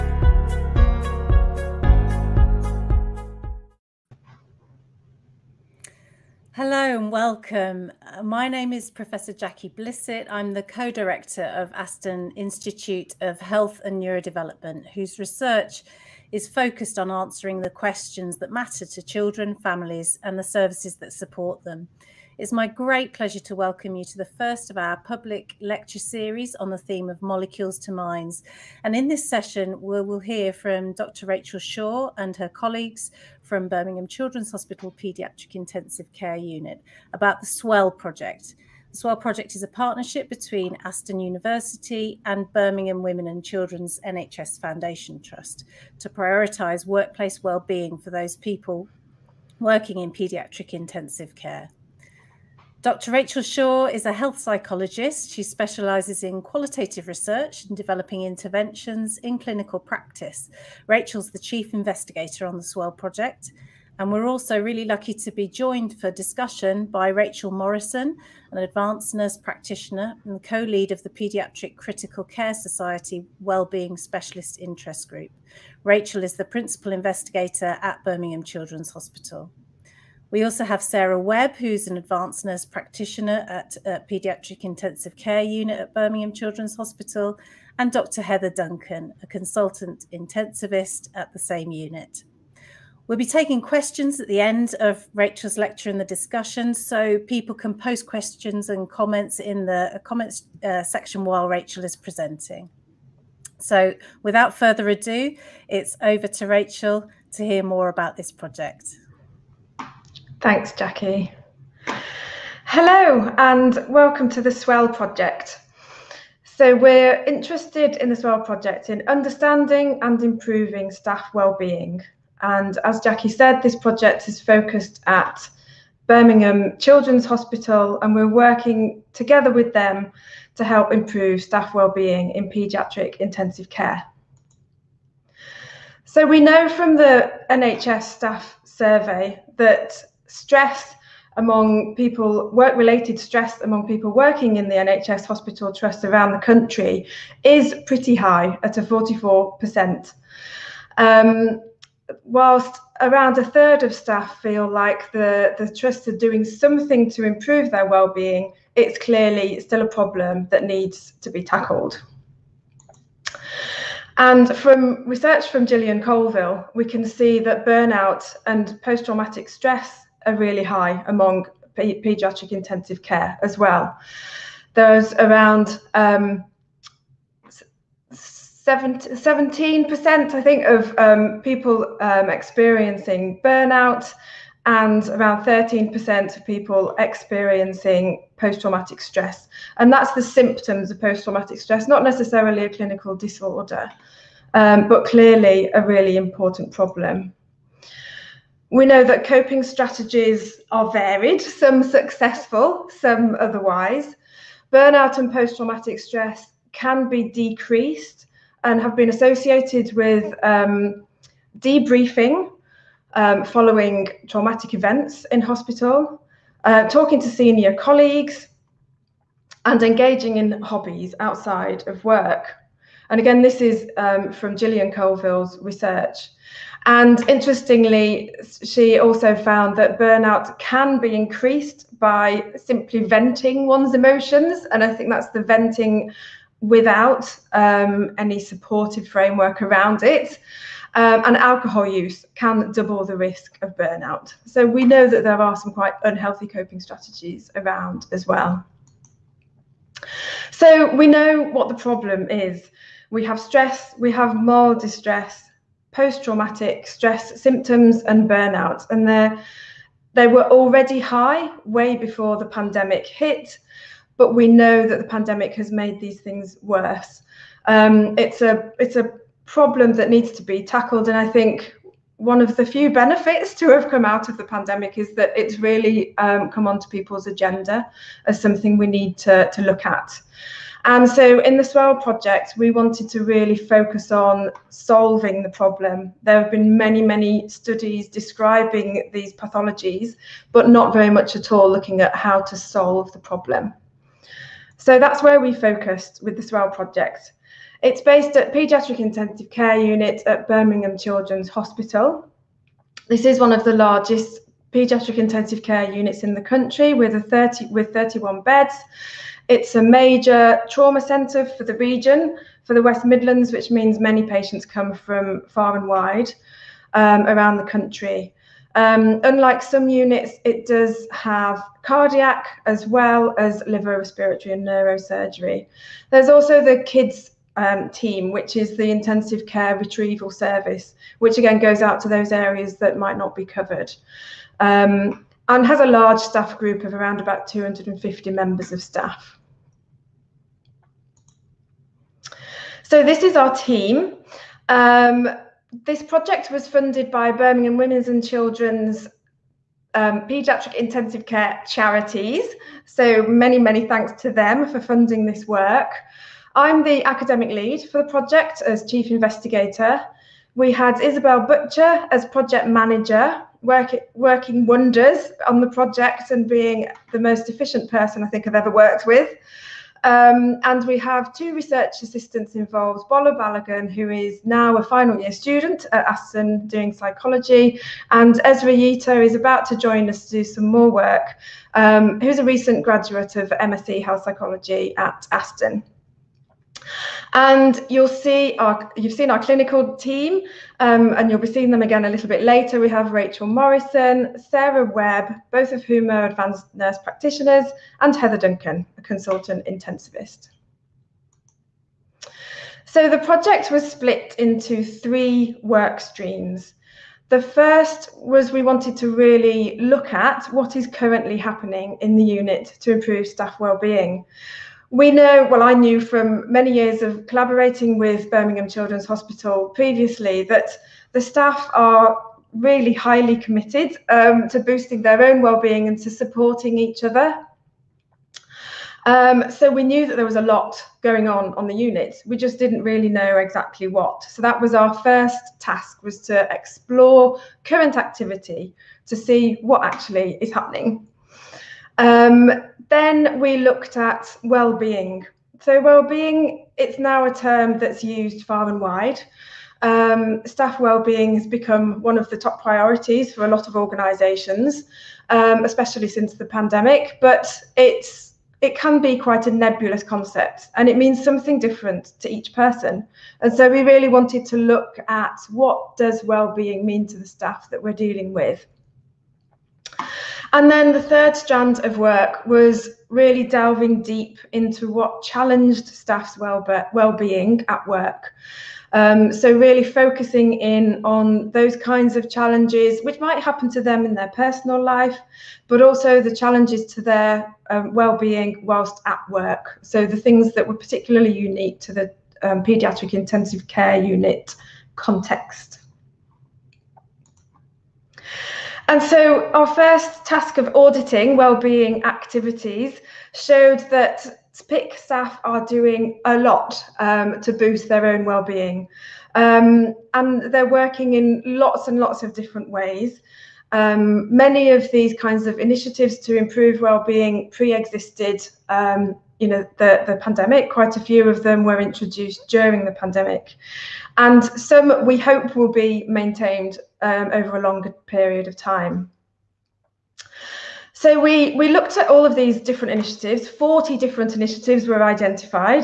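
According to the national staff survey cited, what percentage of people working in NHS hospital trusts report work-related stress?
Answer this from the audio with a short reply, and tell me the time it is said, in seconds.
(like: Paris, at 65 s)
44%, at 148 s.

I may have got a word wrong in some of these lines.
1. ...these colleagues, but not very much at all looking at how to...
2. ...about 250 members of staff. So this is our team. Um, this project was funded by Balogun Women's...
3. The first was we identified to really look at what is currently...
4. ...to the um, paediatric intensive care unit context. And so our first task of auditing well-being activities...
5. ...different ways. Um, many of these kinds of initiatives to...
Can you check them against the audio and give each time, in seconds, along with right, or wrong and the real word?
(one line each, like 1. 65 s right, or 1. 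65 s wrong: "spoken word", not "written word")
1. 289 s wrong: "pathologies", not "colleagues"
2. 337 s wrong: "Birmingham", not "Balogun"
3. 407 s wrong: "wanted", not "identified"
4. 491 s right
5. 512 s right.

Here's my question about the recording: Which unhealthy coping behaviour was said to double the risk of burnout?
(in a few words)
Alcohol use.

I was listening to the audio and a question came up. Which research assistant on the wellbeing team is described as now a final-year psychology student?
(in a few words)
Bola Balogun.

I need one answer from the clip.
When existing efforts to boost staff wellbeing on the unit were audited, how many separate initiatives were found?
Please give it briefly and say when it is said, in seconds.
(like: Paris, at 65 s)
40, at 533 s.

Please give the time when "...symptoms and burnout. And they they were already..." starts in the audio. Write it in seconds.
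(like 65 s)
257 s.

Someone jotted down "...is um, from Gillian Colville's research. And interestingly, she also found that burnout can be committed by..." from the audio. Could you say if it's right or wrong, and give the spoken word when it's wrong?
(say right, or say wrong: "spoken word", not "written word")
wrong: "increased", not "committed".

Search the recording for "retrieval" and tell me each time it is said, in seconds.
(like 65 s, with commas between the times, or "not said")
329 s.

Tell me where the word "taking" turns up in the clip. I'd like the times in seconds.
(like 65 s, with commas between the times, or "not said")
93 s.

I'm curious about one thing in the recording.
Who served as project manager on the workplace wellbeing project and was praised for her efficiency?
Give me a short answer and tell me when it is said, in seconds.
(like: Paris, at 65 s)
Isabel Butcher, at 361 s.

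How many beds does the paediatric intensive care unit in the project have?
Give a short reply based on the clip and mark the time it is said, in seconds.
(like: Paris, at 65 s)
31, at 307 s.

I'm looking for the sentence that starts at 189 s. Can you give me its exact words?
And that's the symptoms of post-traumatic stress, not necessarily a clinical disorder, um, but clearly a really important problem.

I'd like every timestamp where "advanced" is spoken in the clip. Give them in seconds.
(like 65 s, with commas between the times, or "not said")
68 s, 81 s, 396 s.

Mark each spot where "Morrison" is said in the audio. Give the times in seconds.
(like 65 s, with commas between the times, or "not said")
67 s, 393 s.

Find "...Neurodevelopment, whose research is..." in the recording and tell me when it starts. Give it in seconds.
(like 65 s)
14 s.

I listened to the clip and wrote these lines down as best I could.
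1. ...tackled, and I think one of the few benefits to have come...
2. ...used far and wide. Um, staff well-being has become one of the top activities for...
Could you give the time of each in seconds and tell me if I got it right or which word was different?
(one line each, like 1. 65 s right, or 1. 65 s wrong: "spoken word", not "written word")
1. 270 s right
2. 448 s wrong: "priorities", not "activities".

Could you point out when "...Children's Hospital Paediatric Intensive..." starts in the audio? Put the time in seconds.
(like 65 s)
34 s.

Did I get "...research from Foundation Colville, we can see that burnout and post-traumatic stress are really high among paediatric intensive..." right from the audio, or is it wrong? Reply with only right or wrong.
wrong.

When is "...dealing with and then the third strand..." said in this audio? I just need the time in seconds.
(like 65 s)
467 s.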